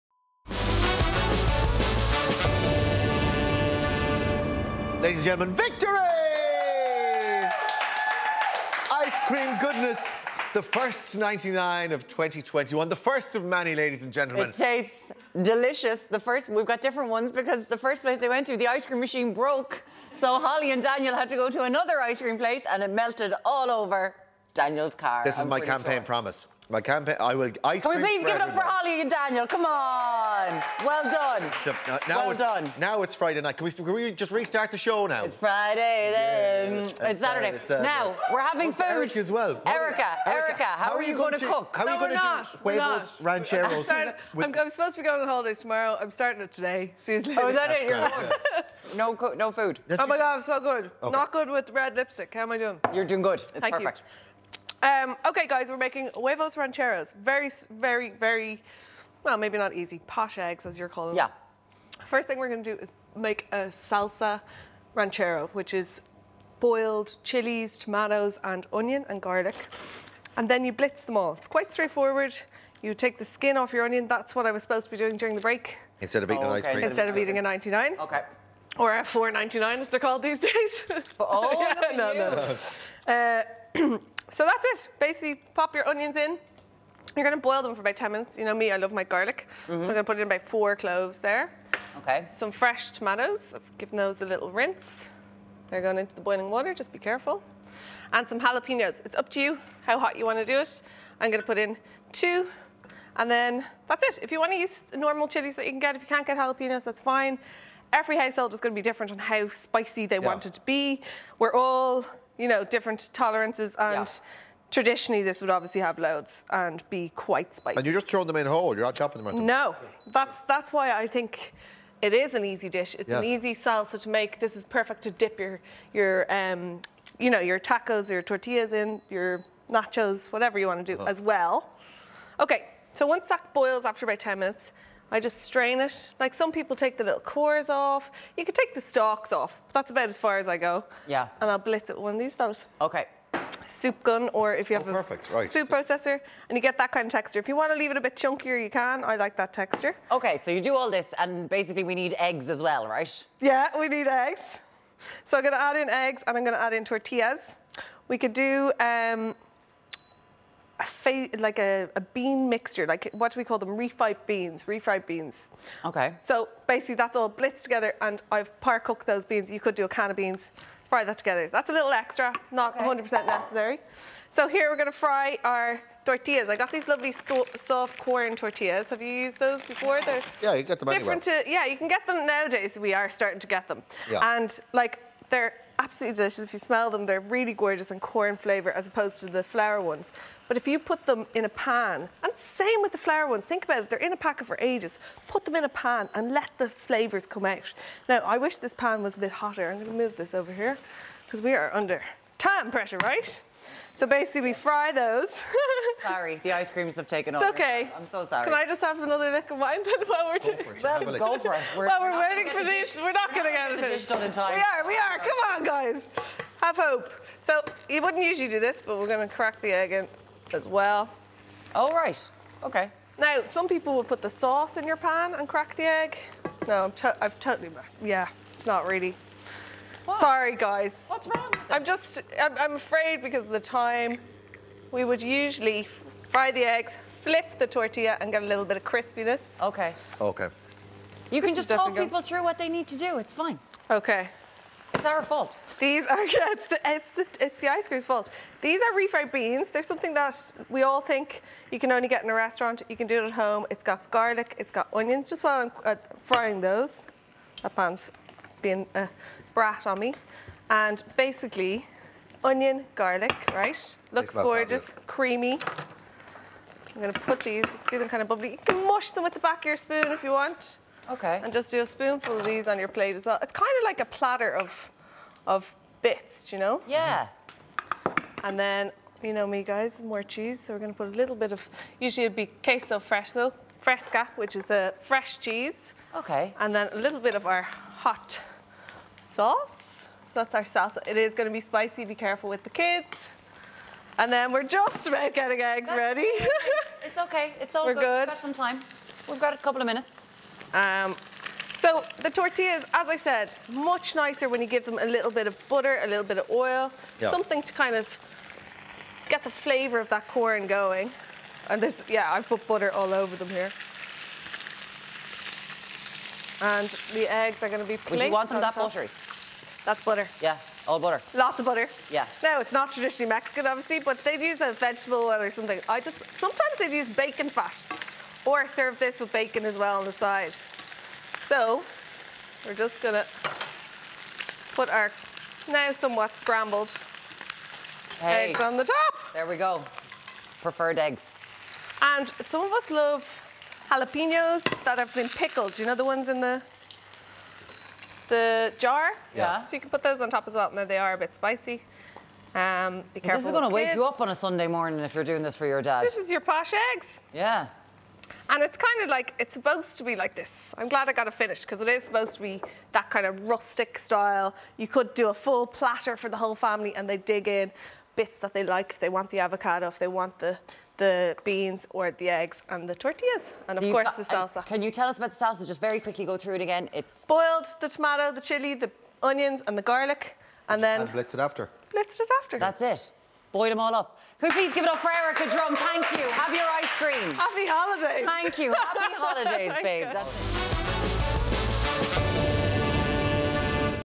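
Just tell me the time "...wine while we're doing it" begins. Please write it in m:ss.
3:29.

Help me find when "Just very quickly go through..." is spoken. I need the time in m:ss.
6:15.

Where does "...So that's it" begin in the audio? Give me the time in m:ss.
1:24.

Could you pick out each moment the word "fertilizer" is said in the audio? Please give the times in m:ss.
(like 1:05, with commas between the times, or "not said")
not said.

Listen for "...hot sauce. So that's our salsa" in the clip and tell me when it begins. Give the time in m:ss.
4:47.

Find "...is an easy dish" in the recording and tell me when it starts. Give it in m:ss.
2:02.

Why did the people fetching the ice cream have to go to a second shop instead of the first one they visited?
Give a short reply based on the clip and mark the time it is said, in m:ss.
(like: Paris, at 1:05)
The ice cream machine broke, at 0:18.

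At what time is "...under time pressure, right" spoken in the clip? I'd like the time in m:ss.
3:21.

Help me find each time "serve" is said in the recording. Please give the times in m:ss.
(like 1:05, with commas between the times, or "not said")
5:28.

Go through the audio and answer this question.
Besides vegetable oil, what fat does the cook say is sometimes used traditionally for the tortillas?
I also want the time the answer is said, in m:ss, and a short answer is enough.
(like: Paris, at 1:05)
Bacon fat, at 5:27.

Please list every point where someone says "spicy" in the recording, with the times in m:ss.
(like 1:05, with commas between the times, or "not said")
1:49, 1:57, 4:51, 5:51.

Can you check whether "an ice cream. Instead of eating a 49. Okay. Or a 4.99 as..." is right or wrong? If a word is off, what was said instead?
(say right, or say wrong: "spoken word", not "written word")
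wrong: "99", not "49".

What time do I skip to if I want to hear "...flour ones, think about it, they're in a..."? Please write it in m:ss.
3:12.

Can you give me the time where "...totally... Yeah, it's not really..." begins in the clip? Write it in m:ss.
3:47.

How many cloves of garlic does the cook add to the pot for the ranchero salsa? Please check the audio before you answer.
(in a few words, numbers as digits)
4.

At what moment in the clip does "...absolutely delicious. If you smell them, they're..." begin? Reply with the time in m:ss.
3:05.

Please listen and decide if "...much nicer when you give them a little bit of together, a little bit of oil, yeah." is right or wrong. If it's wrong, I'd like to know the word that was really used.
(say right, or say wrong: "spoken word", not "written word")
wrong: "butter", not "together".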